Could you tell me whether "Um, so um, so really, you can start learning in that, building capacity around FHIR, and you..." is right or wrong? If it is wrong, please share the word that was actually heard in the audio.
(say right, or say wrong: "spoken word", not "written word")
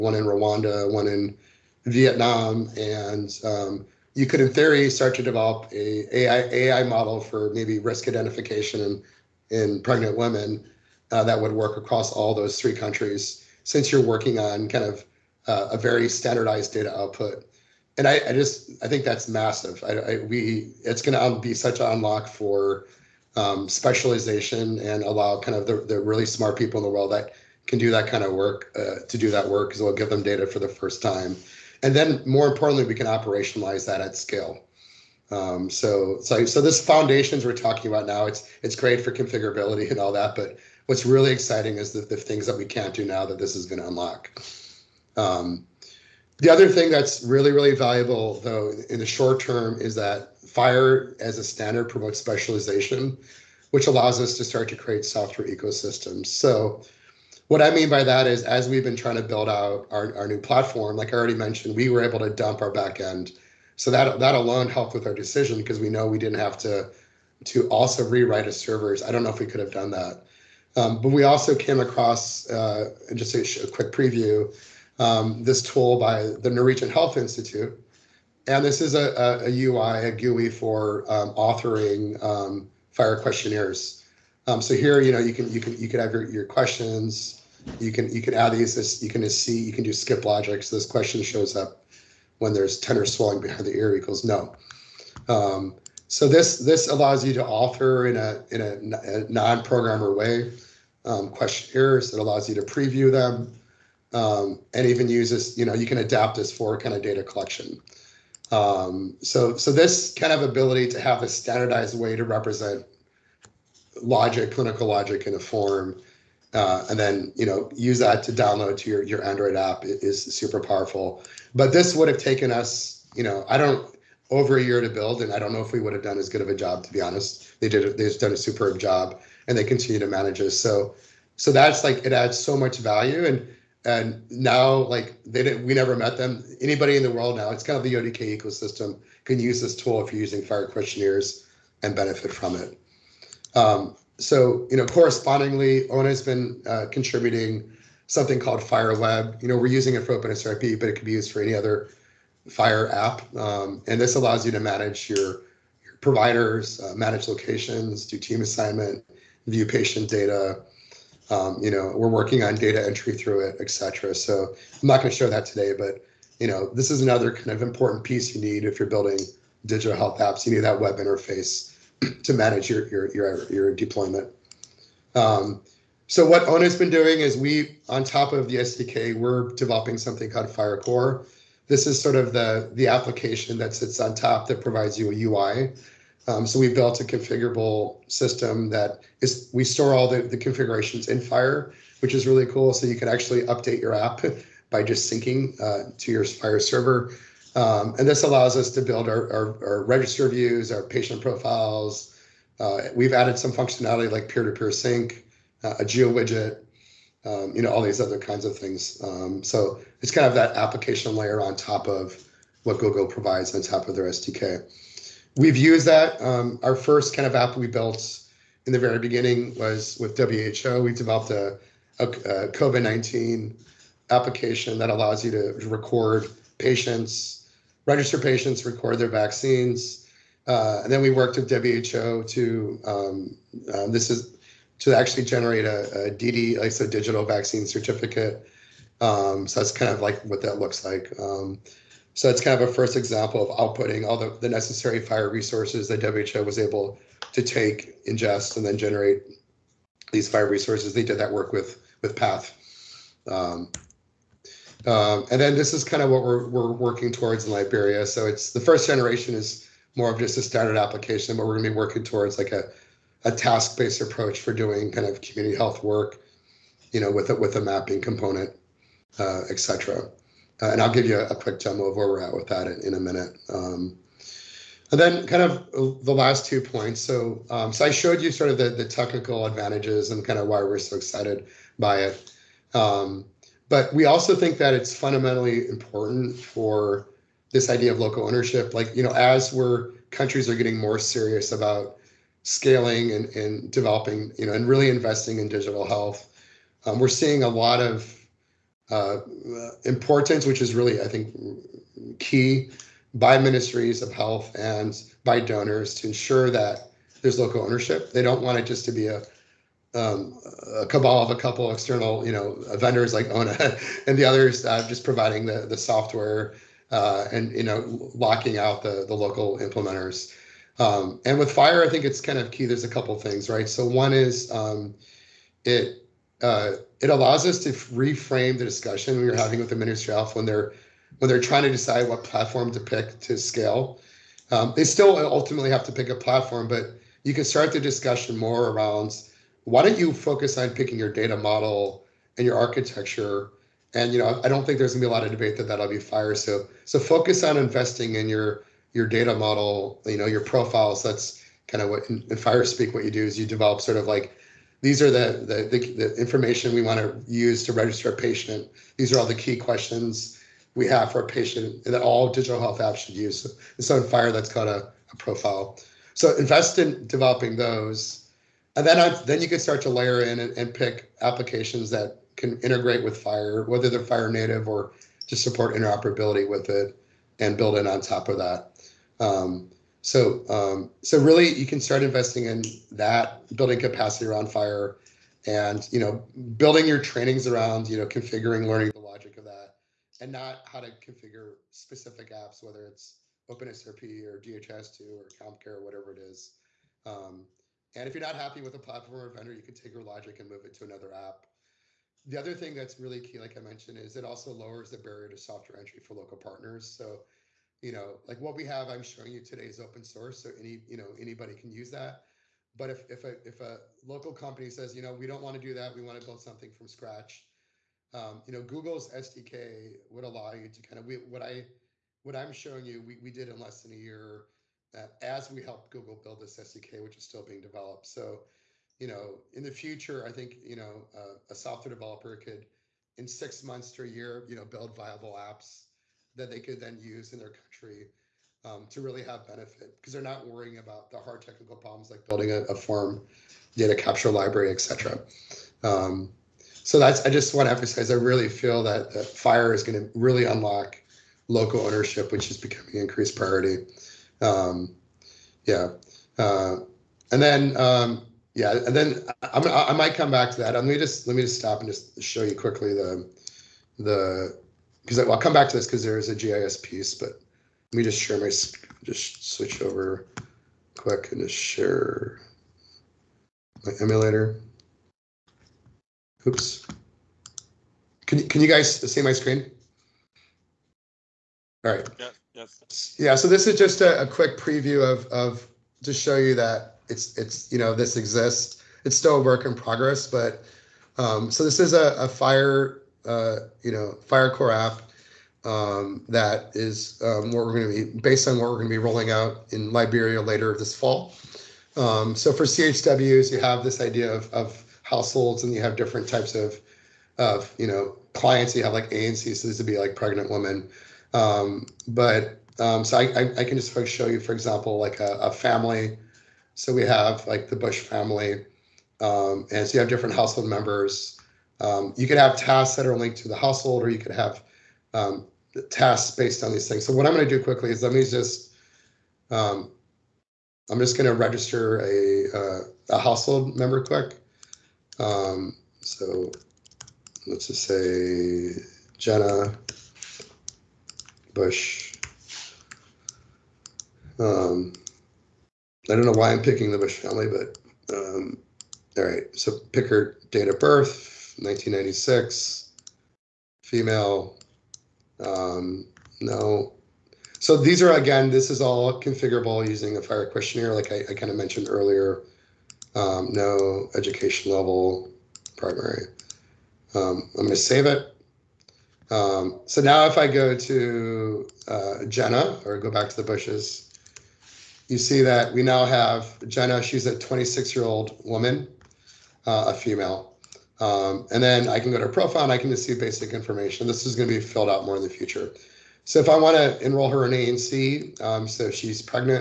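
wrong: "investing", not "learning".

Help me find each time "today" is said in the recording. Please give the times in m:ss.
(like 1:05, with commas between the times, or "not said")
2:45, 6:49.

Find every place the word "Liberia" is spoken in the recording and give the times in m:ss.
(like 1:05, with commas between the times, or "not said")
4:17, 8:19.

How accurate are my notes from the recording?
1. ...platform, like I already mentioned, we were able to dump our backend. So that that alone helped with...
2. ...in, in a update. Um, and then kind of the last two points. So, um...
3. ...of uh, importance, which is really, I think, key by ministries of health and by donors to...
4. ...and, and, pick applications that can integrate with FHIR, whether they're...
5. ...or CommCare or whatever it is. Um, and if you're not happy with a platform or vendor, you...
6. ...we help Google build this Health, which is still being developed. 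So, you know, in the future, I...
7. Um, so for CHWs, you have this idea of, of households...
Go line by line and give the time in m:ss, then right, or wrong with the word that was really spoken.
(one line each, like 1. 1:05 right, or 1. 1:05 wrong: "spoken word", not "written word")
1. 1:00 right
2. 4:32 wrong: "minute", not "update"
3. 4:57 right
4. 6:10 right
5. 6:35 right
6. 7:05 wrong: "SDK", not "Health"
7. 8:21 right.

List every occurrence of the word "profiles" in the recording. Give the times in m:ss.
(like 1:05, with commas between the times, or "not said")
3:21, 5:50, 6:05, 9:42.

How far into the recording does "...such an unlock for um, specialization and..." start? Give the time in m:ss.
0:21.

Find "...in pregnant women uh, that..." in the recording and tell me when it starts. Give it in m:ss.
0:09.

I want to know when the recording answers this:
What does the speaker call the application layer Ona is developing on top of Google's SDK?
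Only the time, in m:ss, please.
3:00.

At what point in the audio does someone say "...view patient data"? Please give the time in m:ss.
2:39.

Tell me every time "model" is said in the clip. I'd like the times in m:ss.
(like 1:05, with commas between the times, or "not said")
0:06, 5:41, 5:49.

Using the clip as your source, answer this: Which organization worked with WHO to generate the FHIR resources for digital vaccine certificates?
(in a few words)
PATH.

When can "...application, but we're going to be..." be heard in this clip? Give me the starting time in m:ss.
4:20.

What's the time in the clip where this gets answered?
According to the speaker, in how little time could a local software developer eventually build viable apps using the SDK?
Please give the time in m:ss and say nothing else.
7:13.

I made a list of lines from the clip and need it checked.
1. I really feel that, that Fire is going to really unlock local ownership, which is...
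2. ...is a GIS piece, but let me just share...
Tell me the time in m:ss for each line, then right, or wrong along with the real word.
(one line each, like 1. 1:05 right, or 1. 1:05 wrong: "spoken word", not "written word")
1. 7:28 wrong: "FHIR", not "Fire"
2. 7:46 right.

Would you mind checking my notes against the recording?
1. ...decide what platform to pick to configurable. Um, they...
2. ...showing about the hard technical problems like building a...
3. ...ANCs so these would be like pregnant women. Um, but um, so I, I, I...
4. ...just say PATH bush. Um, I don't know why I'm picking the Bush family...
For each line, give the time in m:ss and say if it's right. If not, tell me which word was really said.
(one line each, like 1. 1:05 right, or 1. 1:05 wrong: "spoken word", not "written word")
1. 5:31 wrong: "scale", not "configurable"
2. 7:20 wrong: "worrying", not "showing"
3. 8:29 right
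4. 8:57 wrong: "Jenna", not "PATH".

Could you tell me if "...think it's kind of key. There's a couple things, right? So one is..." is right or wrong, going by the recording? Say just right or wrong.
right.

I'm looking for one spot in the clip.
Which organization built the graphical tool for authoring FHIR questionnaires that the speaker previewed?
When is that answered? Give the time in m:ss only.
1:16.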